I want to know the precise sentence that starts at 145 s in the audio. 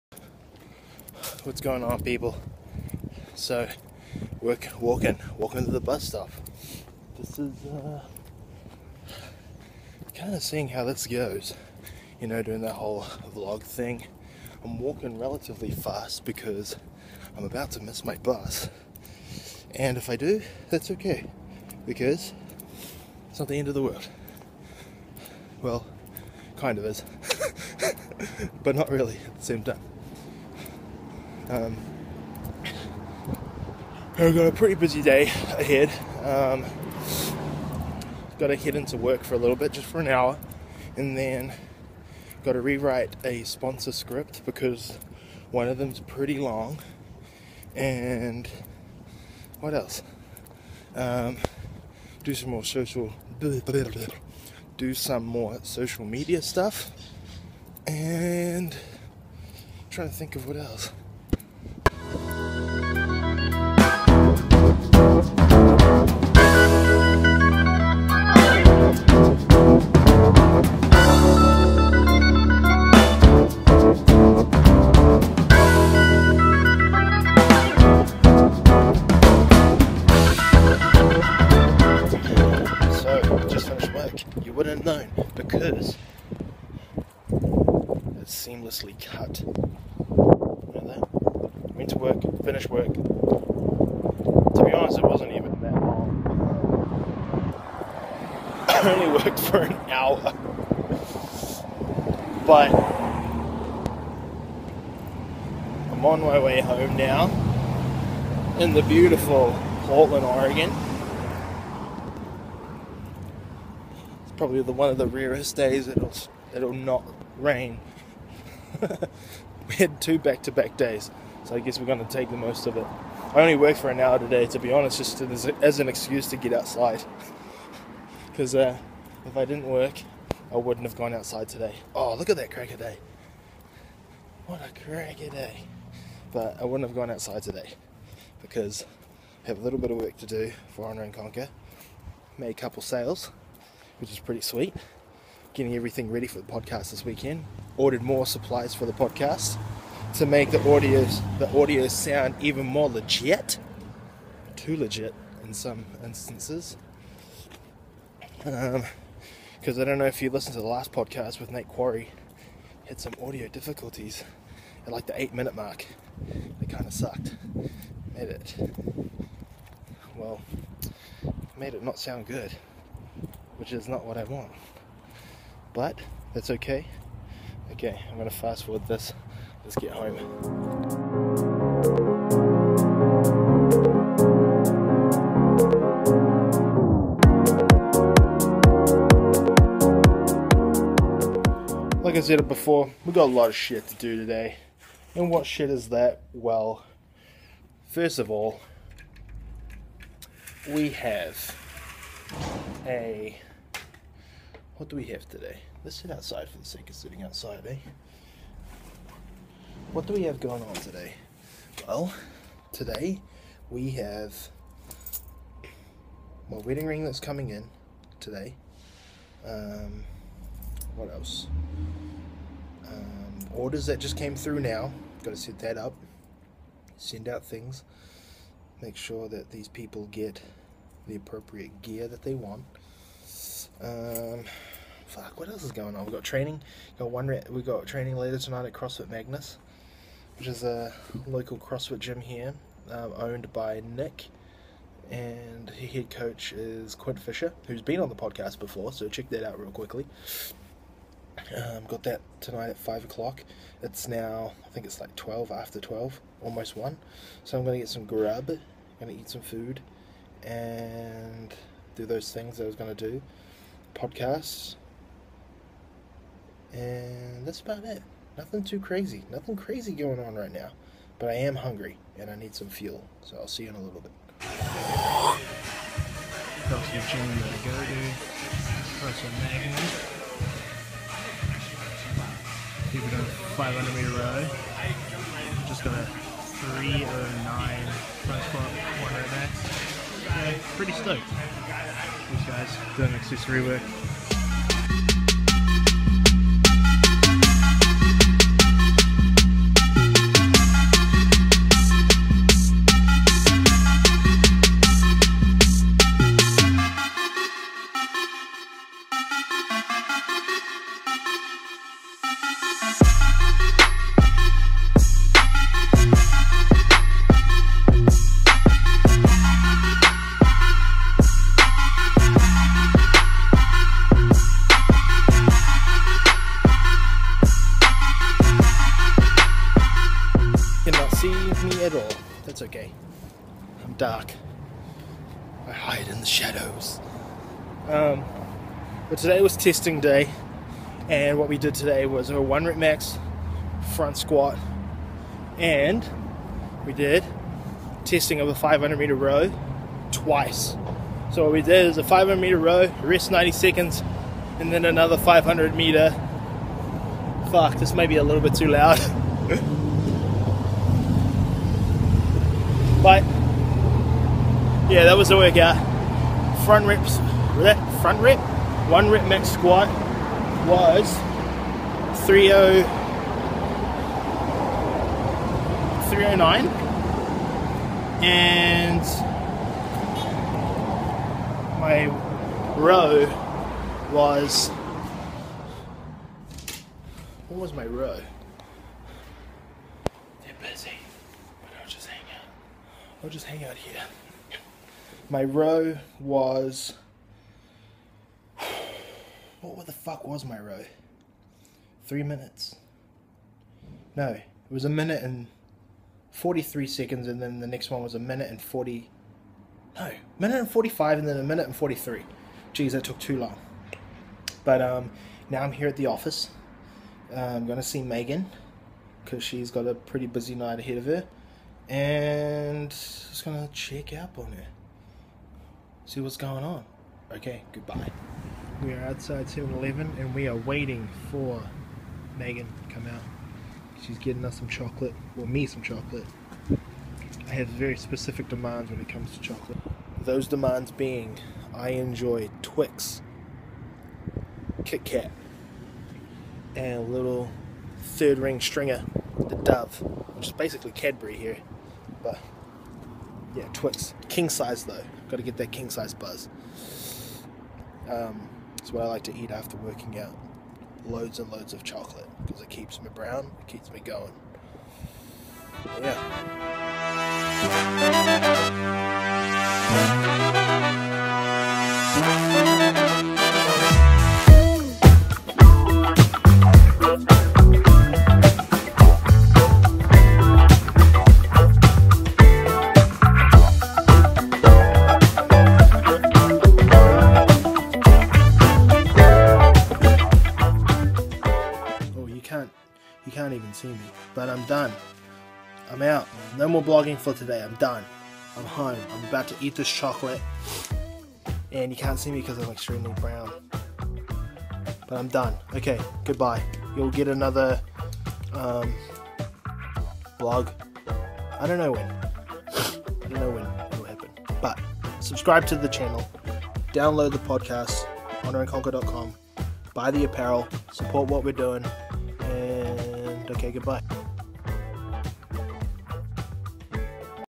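Getting everything ready for the podcast this weekend.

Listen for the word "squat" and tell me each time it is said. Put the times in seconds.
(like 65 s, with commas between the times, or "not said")
288 s, 344 s, 369 s.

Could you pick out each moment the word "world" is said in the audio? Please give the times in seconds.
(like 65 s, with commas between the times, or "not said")
23 s.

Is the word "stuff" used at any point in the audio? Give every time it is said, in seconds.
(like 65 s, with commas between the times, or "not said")
56 s.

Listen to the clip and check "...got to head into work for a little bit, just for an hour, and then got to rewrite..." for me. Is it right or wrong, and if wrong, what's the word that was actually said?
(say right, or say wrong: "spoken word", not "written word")
right.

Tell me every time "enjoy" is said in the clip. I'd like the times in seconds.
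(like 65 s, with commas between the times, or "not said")
441 s.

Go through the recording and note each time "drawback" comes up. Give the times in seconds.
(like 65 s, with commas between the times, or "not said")
not said.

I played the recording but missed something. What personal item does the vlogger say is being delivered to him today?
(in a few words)
Wedding ring.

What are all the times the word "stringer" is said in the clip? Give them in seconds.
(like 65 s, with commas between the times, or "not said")
448 s.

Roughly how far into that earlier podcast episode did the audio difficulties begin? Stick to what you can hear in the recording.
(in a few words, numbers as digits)
8 minute mark.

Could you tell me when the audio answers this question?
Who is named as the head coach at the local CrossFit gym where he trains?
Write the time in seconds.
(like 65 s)
246 s.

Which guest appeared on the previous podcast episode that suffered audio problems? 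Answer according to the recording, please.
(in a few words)
Nate Quarry.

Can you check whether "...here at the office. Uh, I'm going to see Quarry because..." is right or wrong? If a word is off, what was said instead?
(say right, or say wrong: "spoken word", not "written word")
wrong: "Megan", not "Quarry".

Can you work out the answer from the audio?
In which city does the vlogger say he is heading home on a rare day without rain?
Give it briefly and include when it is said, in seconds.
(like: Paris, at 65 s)
Portland, Oregon, at 109 s.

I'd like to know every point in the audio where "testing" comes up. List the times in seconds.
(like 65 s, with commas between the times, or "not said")
339 s, 348 s.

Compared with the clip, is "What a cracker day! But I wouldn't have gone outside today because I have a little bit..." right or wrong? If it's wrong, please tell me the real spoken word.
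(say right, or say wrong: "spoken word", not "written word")
right.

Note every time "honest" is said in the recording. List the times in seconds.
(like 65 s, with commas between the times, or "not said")
94 s, 124 s.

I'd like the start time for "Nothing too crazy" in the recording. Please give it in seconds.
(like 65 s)
268 s.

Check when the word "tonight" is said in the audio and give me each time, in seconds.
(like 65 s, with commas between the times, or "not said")
238 s, 252 s.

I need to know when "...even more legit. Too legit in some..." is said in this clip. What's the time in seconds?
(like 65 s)
152 s.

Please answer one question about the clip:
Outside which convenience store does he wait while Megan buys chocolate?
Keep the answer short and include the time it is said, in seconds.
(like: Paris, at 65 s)
7 Eleven, at 429 s.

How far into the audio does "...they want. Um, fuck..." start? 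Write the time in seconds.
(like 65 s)
232 s.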